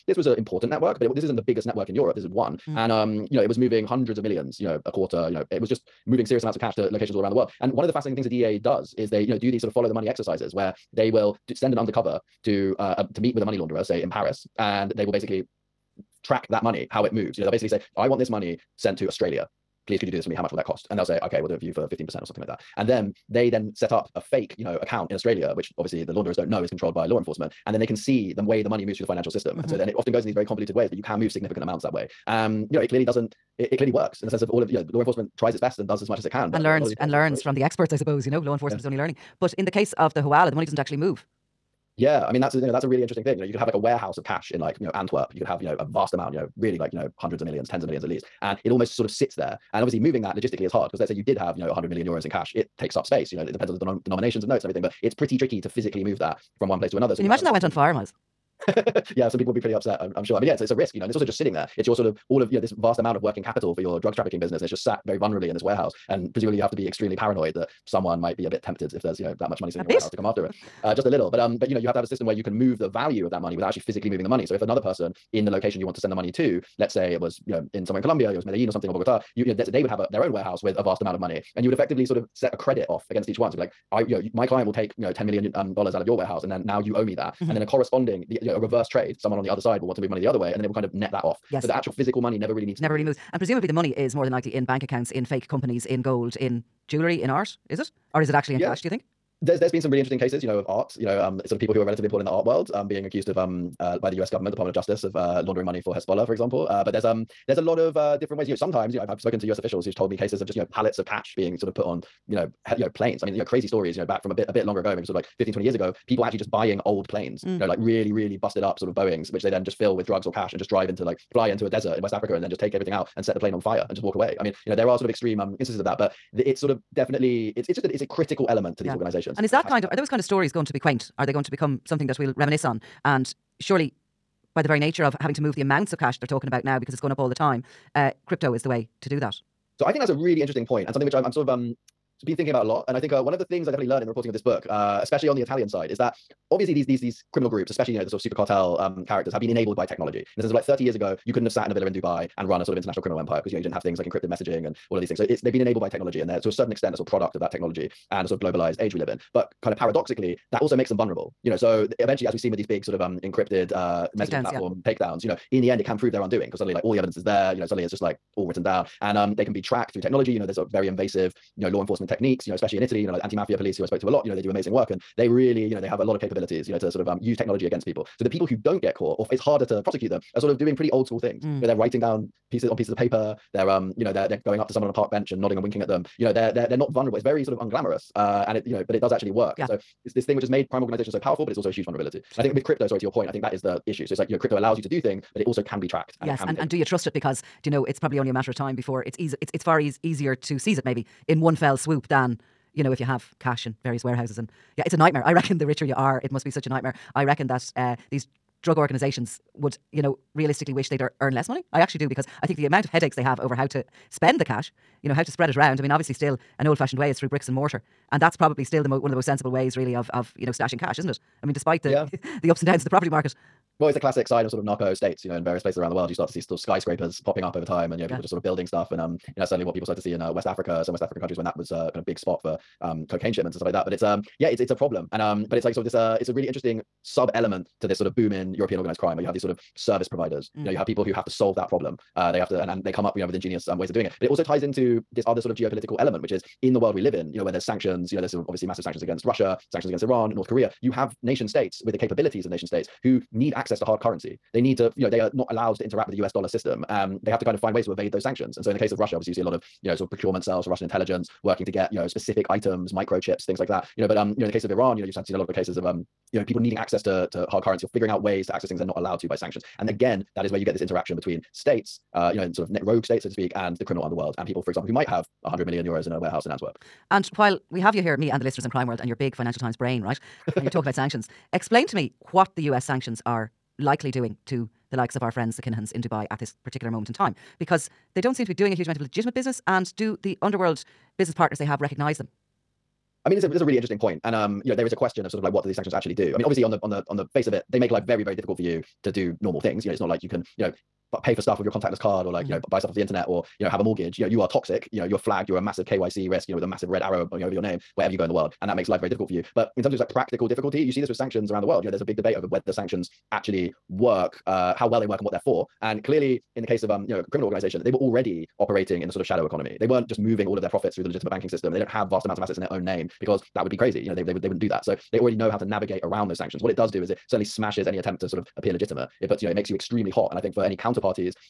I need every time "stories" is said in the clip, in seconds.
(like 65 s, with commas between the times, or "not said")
113 s, 130 s.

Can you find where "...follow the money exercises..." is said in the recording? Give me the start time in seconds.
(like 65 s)
9 s.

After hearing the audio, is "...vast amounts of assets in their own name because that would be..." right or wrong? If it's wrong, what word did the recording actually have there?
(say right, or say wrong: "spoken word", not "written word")
right.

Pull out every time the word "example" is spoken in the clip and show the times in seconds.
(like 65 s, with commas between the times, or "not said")
106 s, 274 s.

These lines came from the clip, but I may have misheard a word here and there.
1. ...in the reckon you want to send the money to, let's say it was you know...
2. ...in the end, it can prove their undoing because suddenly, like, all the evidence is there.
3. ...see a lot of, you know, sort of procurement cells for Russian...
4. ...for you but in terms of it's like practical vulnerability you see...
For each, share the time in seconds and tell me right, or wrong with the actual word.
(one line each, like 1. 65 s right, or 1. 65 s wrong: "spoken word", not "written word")
1. 75 s wrong: "location", not "reckon"
2. 165 s right
3. 259 s right
4. 309 s wrong: "difficulty", not "vulnerability".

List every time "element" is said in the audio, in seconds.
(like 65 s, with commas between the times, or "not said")
128 s, 237 s, 245 s.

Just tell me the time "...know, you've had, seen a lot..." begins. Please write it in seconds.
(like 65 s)
265 s.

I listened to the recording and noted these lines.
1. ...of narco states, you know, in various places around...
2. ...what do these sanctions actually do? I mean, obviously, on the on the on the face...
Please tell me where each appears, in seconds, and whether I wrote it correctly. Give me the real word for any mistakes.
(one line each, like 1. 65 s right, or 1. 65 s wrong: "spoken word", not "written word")
1. 224 s right
2. 295 s right.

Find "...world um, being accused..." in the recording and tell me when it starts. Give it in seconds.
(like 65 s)
102 s.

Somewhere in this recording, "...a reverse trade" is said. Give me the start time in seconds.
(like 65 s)
88 s.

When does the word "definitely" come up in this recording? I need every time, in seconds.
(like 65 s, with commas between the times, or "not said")
126 s, 143 s.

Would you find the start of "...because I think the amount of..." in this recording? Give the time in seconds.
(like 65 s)
212 s.